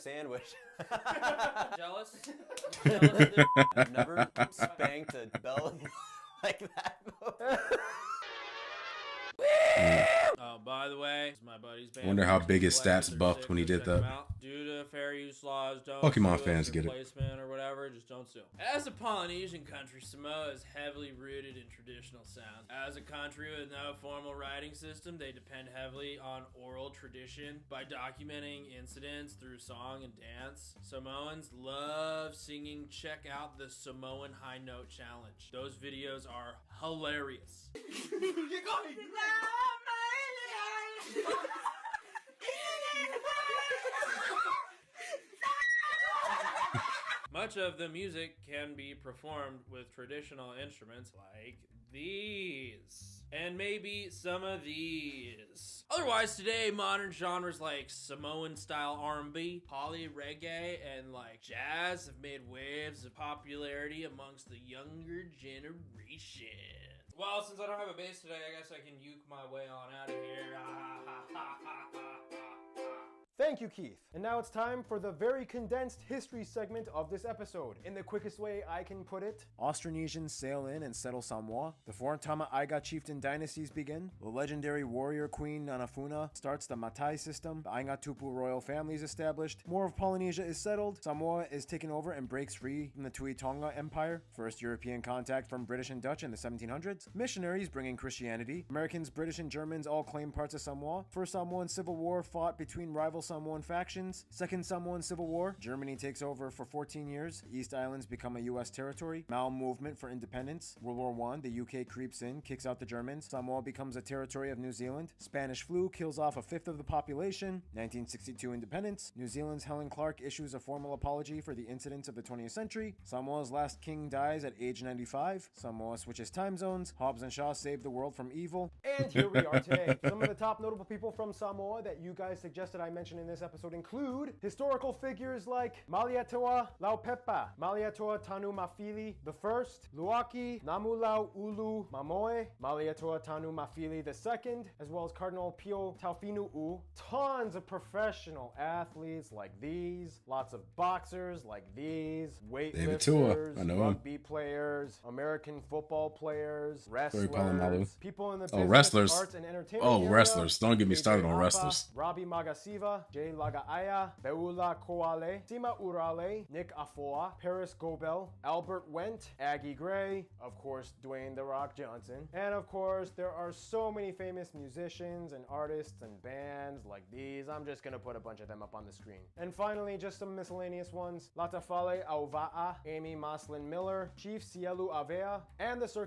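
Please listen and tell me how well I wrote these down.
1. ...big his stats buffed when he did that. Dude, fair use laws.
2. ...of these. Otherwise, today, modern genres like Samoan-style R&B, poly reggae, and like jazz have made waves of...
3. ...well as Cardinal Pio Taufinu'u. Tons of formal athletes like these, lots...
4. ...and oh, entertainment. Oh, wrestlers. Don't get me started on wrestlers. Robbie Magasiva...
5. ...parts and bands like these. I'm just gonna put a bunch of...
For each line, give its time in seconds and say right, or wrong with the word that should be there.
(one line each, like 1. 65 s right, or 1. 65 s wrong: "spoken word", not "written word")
1. 12 s right
2. 54 s right
3. 144 s wrong: "professional", not "formal"
4. 159 s right
5. 175 s wrong: "artists", not "parts".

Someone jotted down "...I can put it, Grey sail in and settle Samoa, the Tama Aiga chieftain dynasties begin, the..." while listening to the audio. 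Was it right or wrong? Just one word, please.
wrong.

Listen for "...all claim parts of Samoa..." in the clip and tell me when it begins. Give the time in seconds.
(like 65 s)
99 s.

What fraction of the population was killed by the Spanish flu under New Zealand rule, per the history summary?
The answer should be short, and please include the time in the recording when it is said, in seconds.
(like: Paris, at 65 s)
a fifth, at 116 s.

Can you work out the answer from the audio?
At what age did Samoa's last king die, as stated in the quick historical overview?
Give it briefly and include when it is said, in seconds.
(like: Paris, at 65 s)
95, at 124 s.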